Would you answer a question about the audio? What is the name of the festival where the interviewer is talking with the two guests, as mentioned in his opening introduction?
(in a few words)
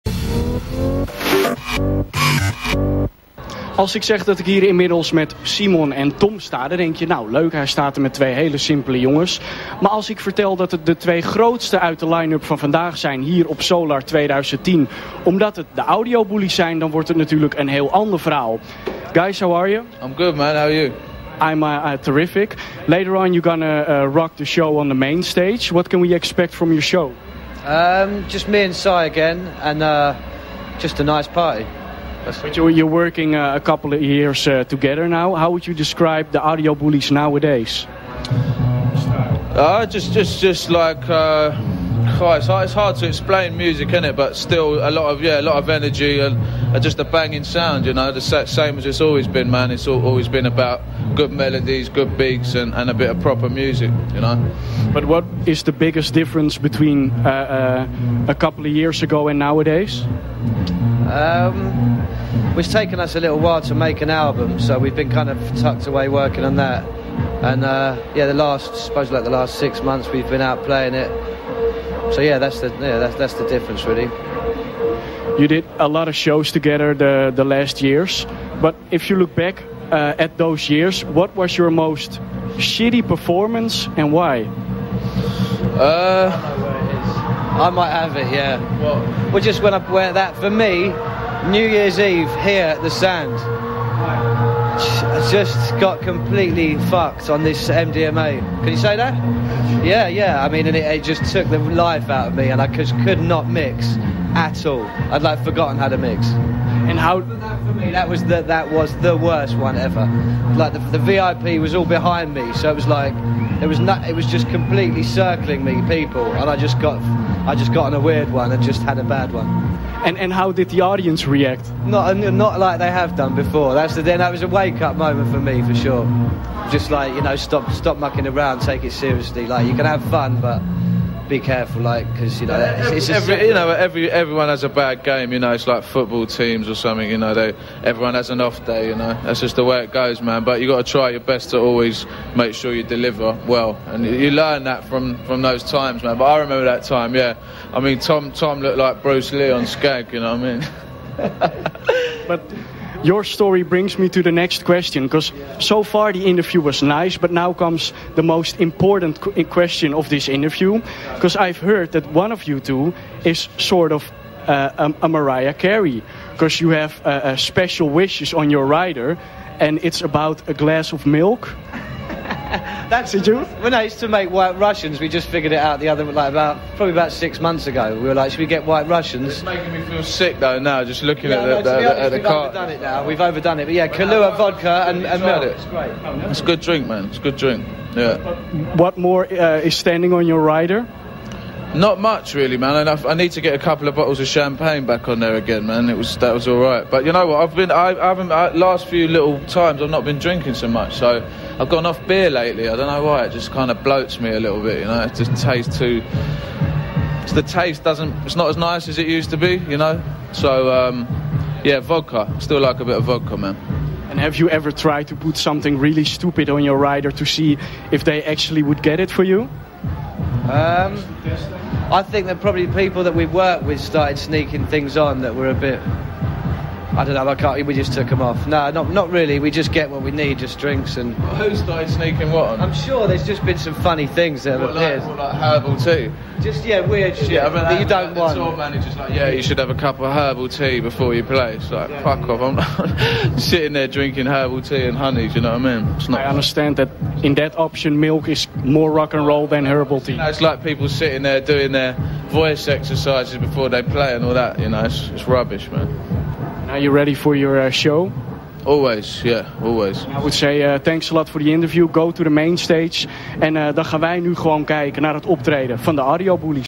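Solar.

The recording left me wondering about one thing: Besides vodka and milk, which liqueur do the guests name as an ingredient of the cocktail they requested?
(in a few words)
Kahlua.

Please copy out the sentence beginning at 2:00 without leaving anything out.
And and how did the audience react?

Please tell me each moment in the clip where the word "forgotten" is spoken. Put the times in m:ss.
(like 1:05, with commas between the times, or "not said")
1:45.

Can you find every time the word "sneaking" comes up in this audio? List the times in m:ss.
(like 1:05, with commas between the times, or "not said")
3:44, 3:51.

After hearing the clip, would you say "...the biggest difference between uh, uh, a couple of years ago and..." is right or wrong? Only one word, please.
right.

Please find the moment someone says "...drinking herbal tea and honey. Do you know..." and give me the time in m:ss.
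4:03.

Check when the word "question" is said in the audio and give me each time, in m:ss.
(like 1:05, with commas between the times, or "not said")
2:34, 2:39.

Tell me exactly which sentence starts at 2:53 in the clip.
When I used to make White Russians, we just figured it out the other like about probably about six months ago.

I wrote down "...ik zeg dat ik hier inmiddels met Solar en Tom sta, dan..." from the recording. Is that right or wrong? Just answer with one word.
wrong.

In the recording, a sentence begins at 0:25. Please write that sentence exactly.
What can we expect from your show?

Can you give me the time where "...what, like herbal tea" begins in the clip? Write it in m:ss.
3:55.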